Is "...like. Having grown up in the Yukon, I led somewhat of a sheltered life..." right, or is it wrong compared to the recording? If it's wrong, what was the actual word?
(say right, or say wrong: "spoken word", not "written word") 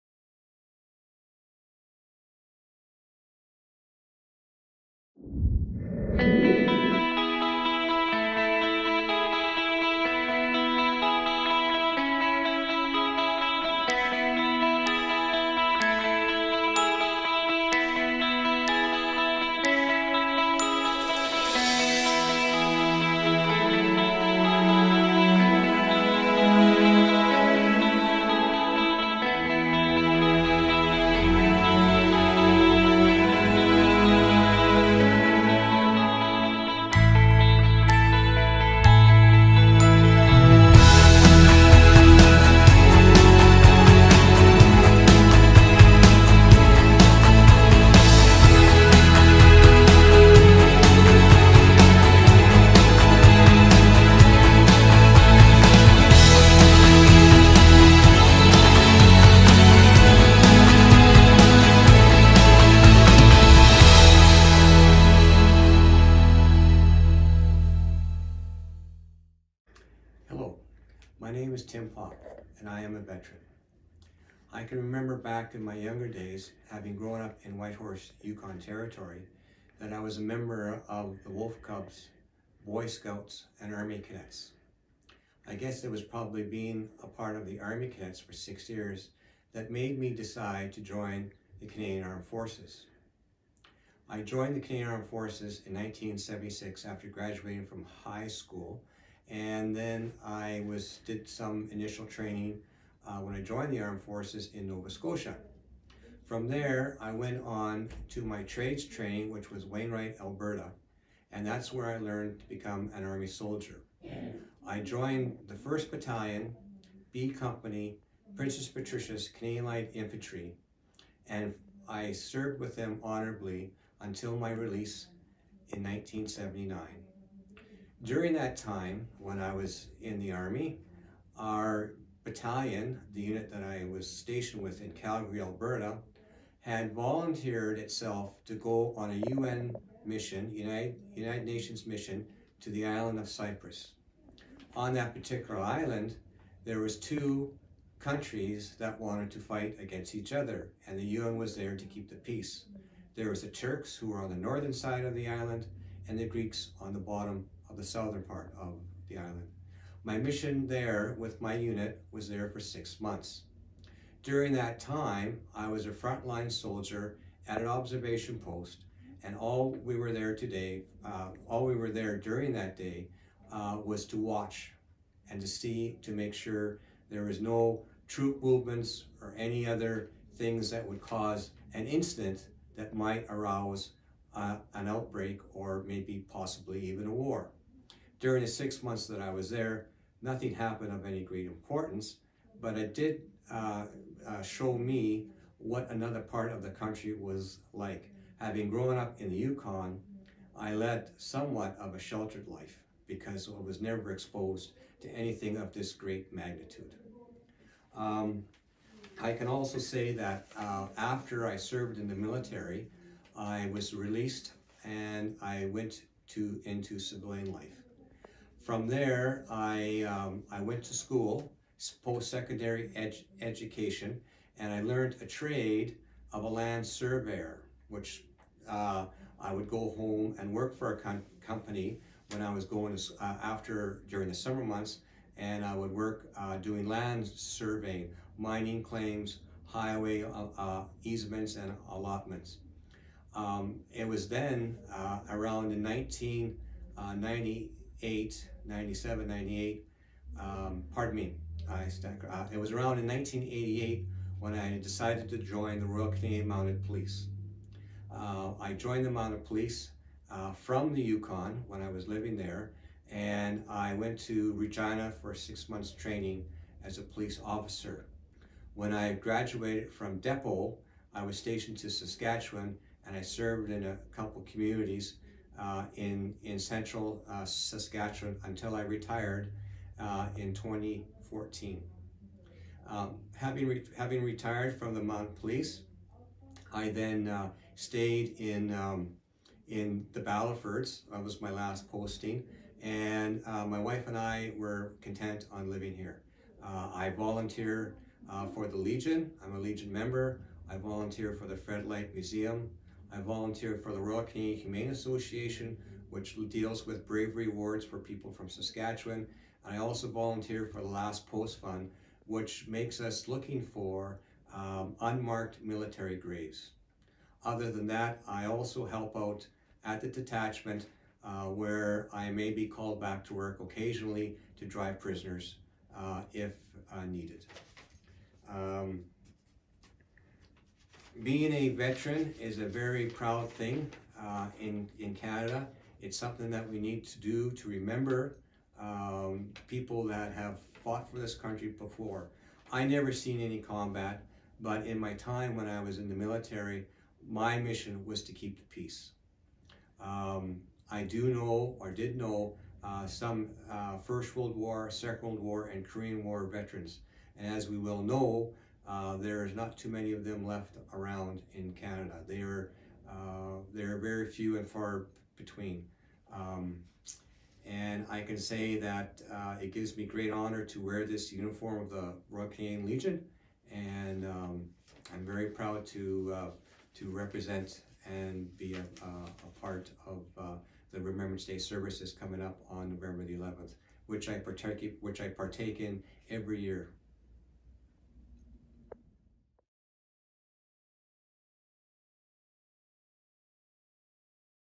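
right.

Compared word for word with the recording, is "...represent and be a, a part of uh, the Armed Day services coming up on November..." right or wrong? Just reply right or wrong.
wrong.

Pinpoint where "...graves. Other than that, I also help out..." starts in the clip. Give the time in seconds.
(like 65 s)
316 s.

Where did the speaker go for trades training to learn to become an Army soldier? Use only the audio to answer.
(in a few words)
Wainwright, Alberta.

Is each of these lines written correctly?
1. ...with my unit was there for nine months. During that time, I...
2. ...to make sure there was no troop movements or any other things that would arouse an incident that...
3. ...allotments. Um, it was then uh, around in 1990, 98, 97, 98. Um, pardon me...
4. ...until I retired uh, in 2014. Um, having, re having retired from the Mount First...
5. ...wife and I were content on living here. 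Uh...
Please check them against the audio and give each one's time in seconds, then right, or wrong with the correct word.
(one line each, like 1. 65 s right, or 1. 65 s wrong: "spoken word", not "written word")
1. 161 s wrong: "six", not "nine"
2. 176 s wrong: "cause", not "arouse"
3. 241 s right
4. 278 s wrong: "Police", not "First"
5. 293 s right.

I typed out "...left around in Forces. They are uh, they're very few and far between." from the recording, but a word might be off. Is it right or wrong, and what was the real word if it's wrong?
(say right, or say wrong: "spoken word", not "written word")
wrong: "Canada", not "Forces".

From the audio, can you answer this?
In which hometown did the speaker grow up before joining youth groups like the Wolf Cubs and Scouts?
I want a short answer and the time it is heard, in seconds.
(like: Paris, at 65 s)
Whitehorse, at 77 s.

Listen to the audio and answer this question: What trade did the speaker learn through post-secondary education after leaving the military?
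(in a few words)
land surveyor.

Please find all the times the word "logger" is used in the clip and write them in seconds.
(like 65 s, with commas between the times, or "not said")
not said.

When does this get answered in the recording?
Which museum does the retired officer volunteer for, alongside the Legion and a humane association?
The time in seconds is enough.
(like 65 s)
301 s.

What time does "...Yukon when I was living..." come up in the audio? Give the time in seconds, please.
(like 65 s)
261 s.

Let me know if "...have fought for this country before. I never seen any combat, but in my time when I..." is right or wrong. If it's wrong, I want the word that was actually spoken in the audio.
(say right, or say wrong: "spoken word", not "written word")
right.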